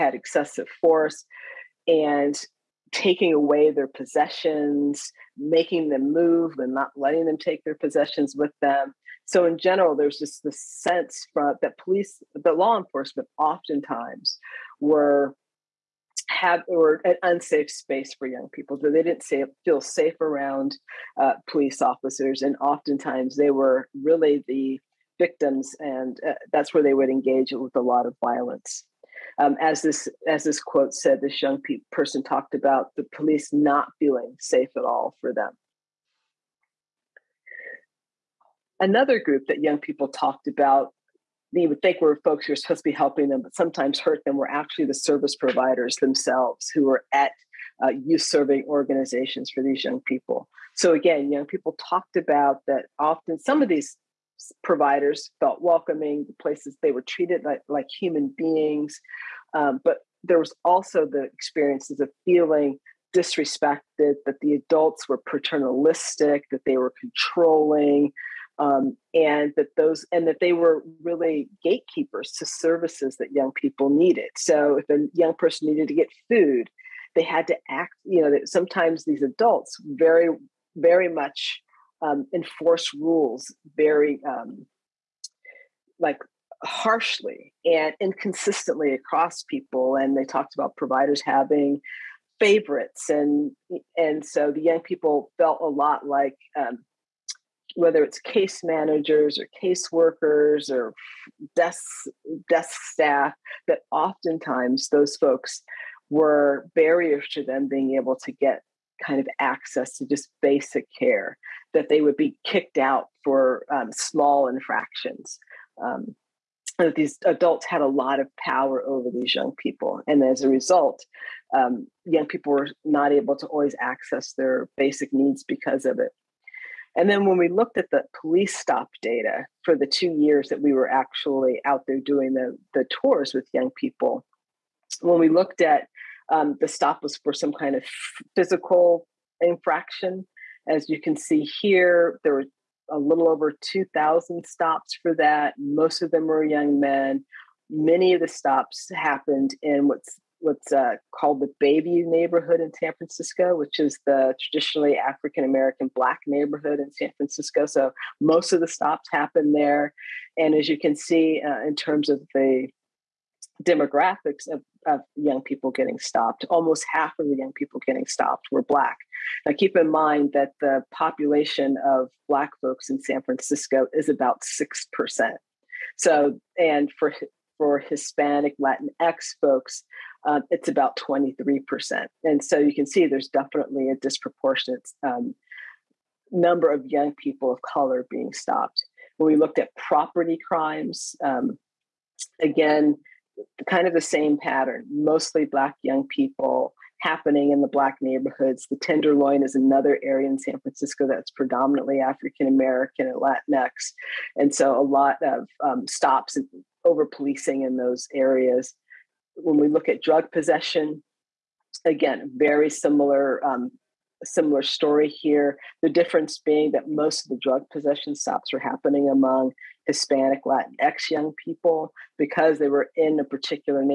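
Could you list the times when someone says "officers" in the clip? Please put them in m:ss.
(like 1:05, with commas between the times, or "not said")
0:21.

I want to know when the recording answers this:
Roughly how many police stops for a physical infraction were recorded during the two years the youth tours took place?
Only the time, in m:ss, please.
2:22.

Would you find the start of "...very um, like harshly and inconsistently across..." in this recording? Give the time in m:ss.
1:23.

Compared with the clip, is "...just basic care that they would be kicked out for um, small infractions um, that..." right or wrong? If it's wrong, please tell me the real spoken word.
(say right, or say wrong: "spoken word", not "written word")
right.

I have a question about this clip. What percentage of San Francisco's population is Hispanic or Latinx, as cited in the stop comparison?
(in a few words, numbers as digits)
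23%.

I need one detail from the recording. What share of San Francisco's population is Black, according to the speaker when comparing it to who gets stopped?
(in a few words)
6%.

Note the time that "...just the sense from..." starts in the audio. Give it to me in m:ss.
0:10.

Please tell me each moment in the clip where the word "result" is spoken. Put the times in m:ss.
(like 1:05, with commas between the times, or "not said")
2:00.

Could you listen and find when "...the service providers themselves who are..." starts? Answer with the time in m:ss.
0:44.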